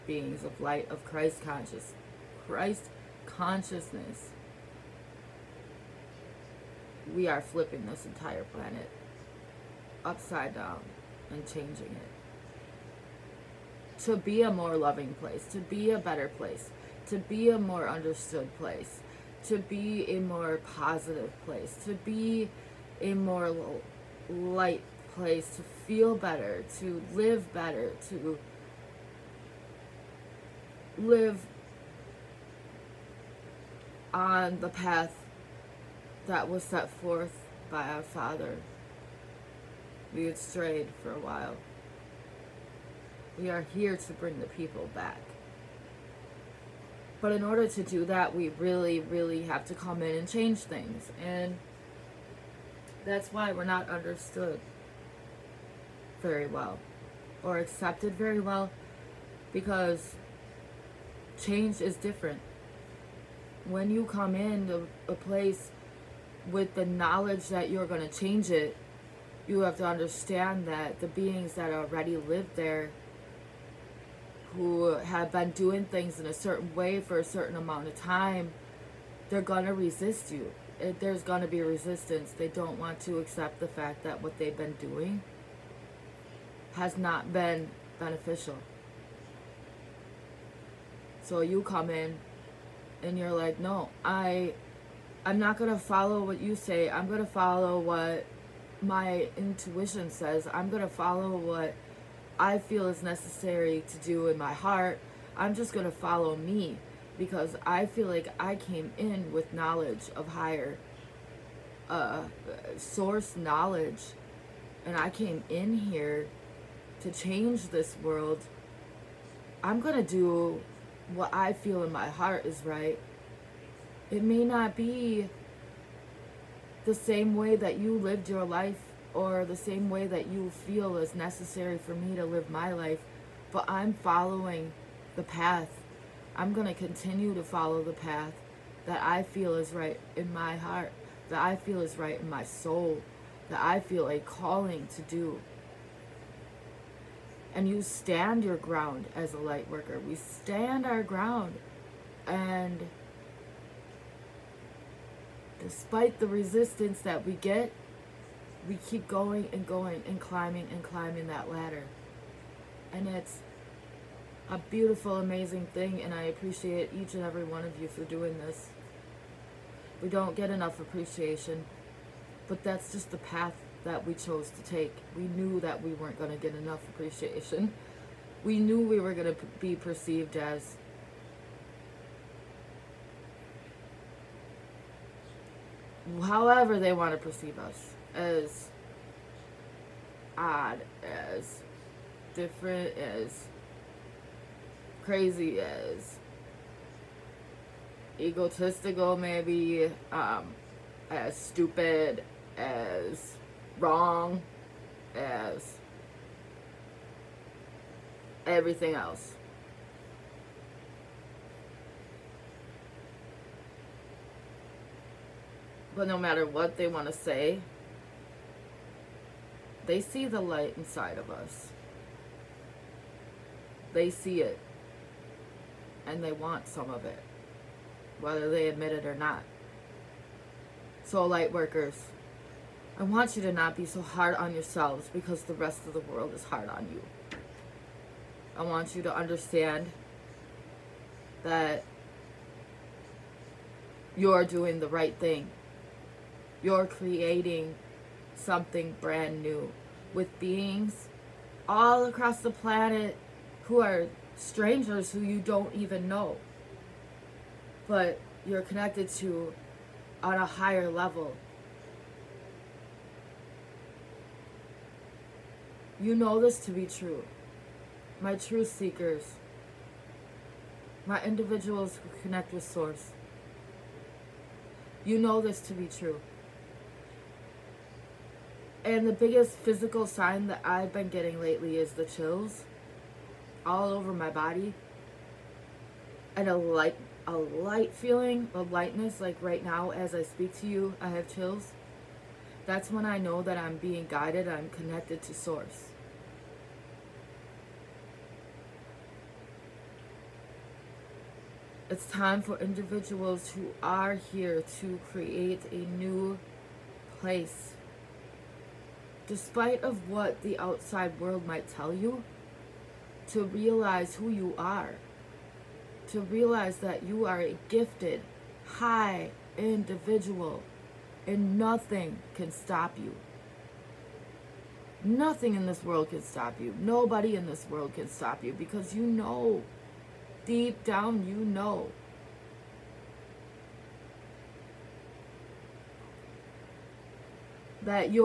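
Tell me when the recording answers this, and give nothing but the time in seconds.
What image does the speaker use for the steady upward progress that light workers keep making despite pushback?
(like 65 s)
160 s.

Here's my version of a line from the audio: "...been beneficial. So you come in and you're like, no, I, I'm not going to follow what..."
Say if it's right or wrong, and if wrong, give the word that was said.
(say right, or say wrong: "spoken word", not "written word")
right.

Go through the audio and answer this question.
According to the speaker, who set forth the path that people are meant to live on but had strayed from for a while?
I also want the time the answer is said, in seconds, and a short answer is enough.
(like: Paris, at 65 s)
our Father, at 37 s.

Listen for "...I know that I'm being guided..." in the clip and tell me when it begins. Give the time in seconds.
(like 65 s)
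293 s.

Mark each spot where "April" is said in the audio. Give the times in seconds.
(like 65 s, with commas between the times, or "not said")
not said.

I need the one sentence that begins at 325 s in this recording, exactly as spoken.
Nothing in this world can stop you.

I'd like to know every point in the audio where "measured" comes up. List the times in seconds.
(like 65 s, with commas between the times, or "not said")
not said.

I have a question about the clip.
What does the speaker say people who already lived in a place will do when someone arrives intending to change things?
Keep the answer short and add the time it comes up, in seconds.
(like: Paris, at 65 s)
resist you, at 79 s.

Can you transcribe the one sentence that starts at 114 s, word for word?
And I came in here to change this world.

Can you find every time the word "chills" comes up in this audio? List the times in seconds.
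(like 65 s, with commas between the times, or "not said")
282 s, 291 s.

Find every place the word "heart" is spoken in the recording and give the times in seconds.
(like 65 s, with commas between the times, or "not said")
104 s, 122 s, 140 s.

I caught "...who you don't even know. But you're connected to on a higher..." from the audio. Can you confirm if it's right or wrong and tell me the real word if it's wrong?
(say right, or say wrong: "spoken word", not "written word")
right.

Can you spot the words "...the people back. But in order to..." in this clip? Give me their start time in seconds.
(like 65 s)
44 s.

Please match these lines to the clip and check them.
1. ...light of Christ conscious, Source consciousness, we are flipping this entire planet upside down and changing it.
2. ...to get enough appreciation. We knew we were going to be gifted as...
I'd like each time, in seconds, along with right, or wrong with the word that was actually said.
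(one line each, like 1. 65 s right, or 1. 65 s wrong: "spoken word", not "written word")
1. 0 s wrong: "Christ", not "Source"
2. 176 s wrong: "perceived", not "gifted".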